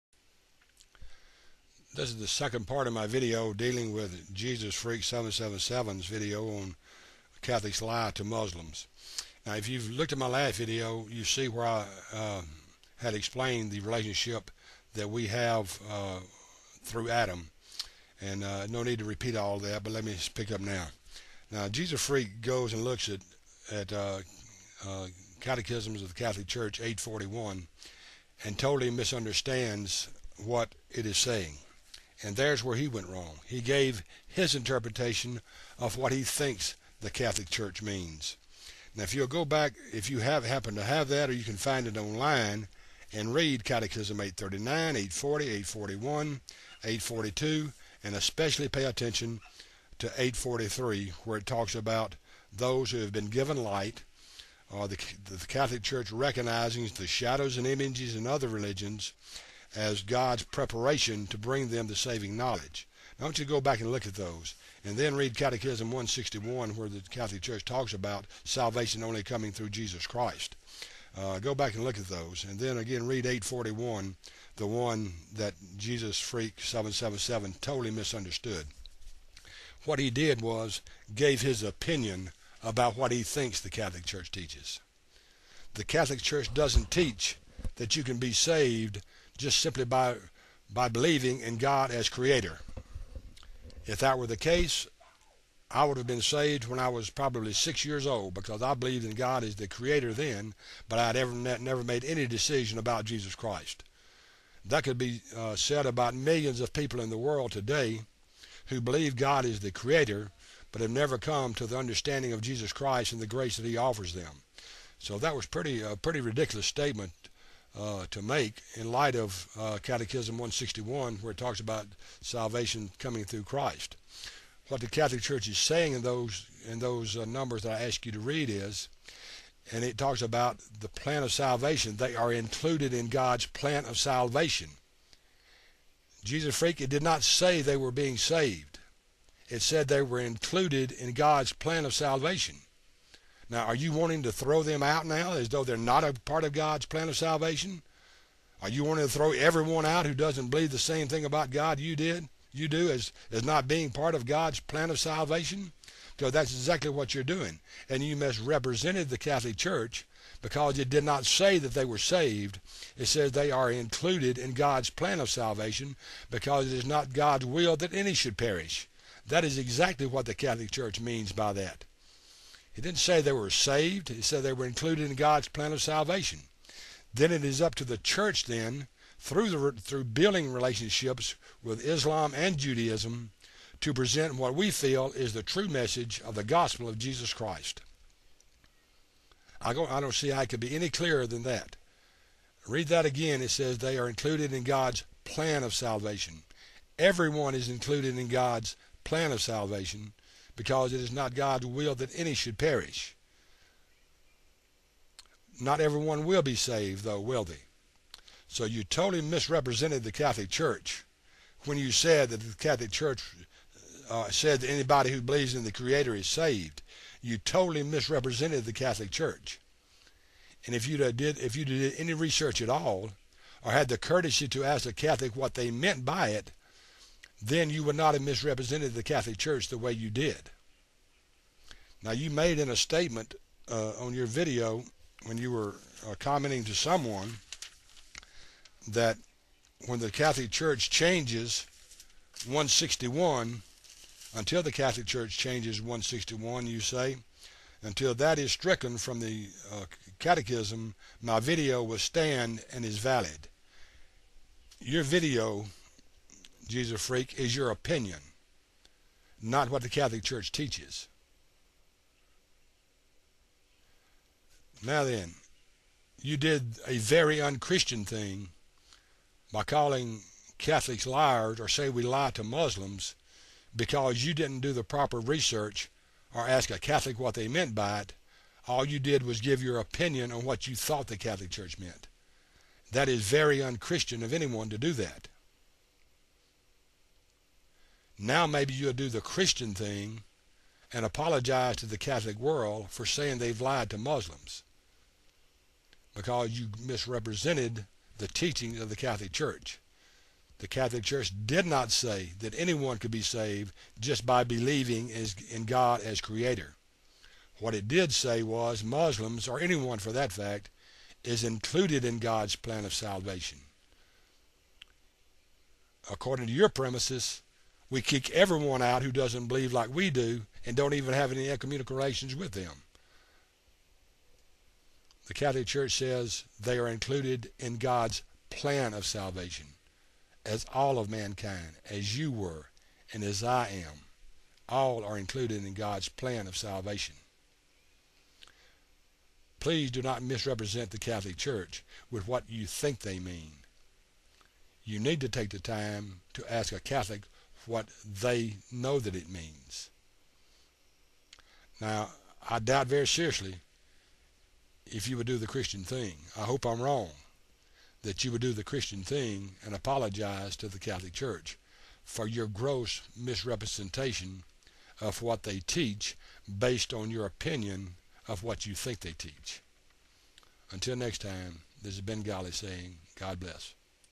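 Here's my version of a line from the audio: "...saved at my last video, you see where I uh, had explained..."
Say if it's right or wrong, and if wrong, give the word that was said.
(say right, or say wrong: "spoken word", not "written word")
wrong: "looked", not "saved".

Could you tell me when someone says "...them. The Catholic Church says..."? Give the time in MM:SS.
05:22.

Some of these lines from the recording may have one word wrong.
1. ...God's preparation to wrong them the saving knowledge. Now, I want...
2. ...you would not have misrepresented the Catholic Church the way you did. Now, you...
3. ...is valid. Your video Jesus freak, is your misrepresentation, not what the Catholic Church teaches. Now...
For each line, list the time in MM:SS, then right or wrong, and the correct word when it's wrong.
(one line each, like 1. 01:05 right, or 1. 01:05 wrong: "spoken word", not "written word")
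1. 01:00 wrong: "bring", not "wrong"
2. 03:47 right
3. 04:12 wrong: "opinion", not "misrepresentation".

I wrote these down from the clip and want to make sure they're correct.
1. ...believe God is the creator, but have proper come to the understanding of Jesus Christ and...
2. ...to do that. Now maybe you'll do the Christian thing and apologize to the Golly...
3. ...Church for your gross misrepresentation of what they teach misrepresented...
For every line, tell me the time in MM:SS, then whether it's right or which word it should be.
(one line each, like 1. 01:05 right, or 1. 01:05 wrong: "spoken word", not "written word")
1. 01:48 wrong: "never", not "proper"
2. 04:44 wrong: "Catholic", not "Golly"
3. 06:01 wrong: "based", not "misrepresented".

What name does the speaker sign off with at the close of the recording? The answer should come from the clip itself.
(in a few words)
Golly.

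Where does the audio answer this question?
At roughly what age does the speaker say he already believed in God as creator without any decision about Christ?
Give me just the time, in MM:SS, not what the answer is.
01:37.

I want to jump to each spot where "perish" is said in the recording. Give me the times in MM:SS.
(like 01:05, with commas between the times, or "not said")
02:48, 03:22.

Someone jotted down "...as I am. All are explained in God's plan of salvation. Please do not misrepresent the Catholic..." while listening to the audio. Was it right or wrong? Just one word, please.
wrong.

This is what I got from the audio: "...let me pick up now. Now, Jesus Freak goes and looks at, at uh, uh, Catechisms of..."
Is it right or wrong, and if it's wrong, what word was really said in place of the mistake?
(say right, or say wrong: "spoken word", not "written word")
right.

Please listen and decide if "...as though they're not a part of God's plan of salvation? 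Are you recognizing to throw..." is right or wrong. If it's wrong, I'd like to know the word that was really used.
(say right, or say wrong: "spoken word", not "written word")
wrong: "wanting", not "recognizing".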